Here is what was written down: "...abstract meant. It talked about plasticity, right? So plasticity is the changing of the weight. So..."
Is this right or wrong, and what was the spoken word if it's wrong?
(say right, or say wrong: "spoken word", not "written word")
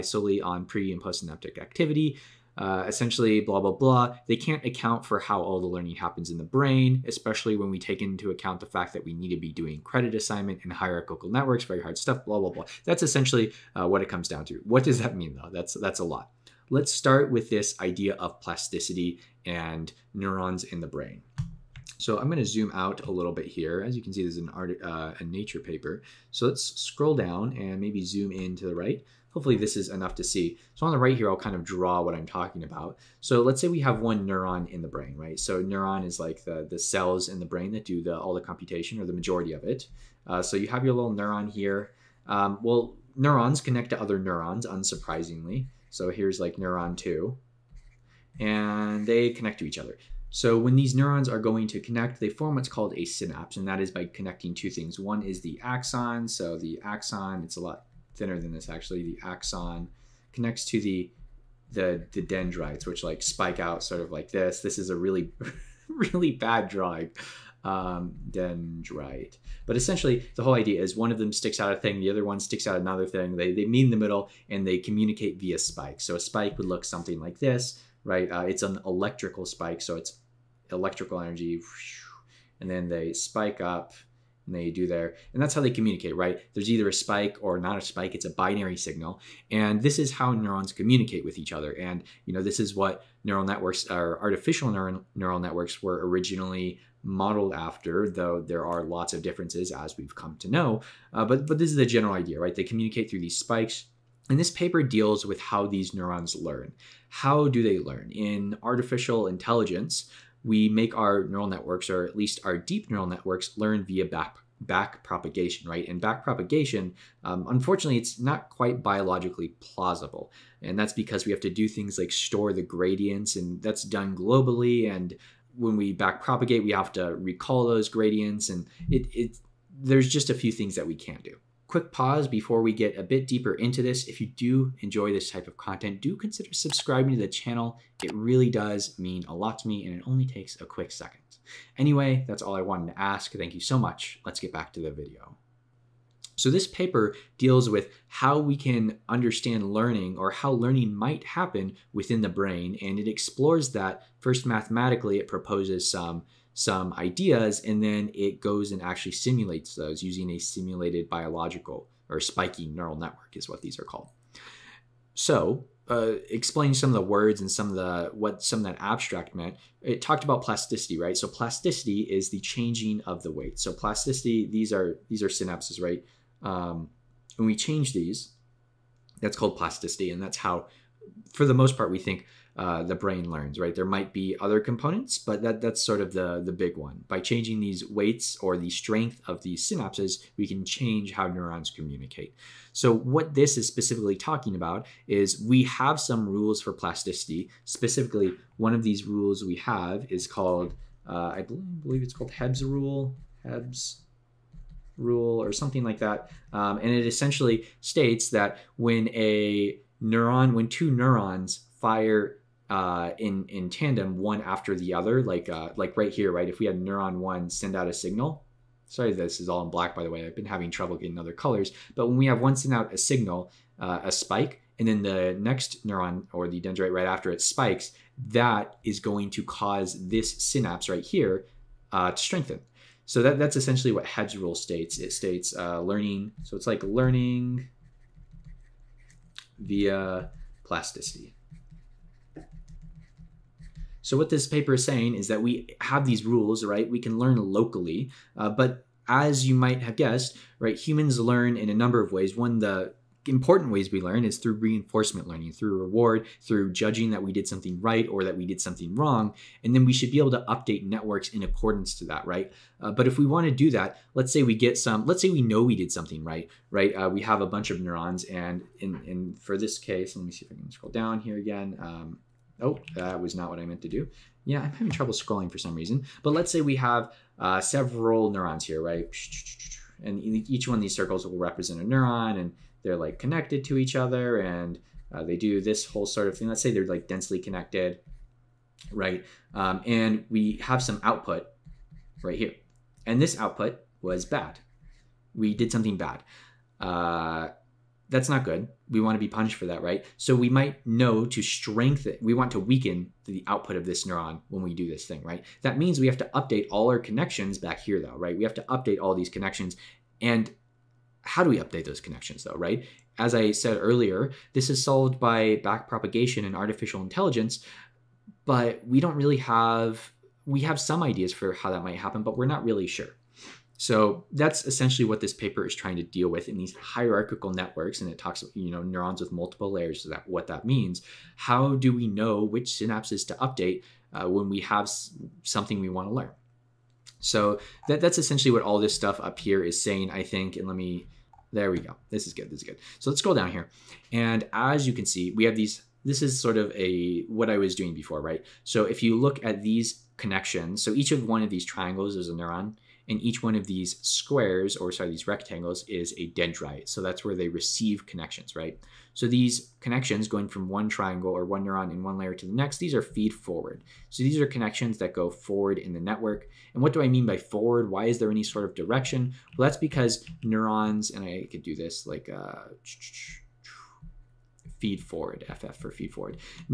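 right.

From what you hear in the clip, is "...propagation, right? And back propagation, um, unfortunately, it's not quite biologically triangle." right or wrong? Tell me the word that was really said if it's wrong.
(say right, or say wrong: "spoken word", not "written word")
wrong: "plausible", not "triangle".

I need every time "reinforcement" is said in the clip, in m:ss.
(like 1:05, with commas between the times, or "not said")
4:14.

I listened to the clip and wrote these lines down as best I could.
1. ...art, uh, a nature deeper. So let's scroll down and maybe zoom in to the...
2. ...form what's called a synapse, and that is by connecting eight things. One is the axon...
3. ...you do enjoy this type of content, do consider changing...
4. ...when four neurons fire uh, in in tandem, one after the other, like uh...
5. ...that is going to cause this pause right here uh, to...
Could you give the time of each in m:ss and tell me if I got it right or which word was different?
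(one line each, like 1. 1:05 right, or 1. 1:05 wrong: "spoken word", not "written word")
1. 0:24 wrong: "paper", not "deeper"
2. 0:52 wrong: "two", not "eight"
3. 2:14 wrong: "subscribing", not "changing"
4. 3:30 wrong: "two", not "four"
5. 3:48 wrong: "synapse", not "pause".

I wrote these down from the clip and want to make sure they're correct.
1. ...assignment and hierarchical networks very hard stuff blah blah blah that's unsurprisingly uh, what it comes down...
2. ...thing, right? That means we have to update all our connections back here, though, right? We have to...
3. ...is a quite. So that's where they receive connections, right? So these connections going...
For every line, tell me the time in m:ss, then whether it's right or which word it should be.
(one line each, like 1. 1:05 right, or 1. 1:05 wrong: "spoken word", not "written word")
1. 0:10 wrong: "essentially", not "unsurprisingly"
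2. 5:05 right
3. 5:55 wrong: "dendrite", not "quite".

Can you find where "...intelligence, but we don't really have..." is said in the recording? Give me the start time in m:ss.
5:17.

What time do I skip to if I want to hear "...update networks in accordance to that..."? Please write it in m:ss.
4:20.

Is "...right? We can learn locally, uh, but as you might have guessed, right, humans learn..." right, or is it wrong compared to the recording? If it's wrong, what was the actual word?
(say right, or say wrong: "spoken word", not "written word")
right.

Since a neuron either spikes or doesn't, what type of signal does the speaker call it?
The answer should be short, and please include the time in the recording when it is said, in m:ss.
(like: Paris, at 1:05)
binary signal, at 1:28.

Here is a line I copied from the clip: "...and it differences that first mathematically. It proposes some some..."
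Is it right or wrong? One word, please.
wrong.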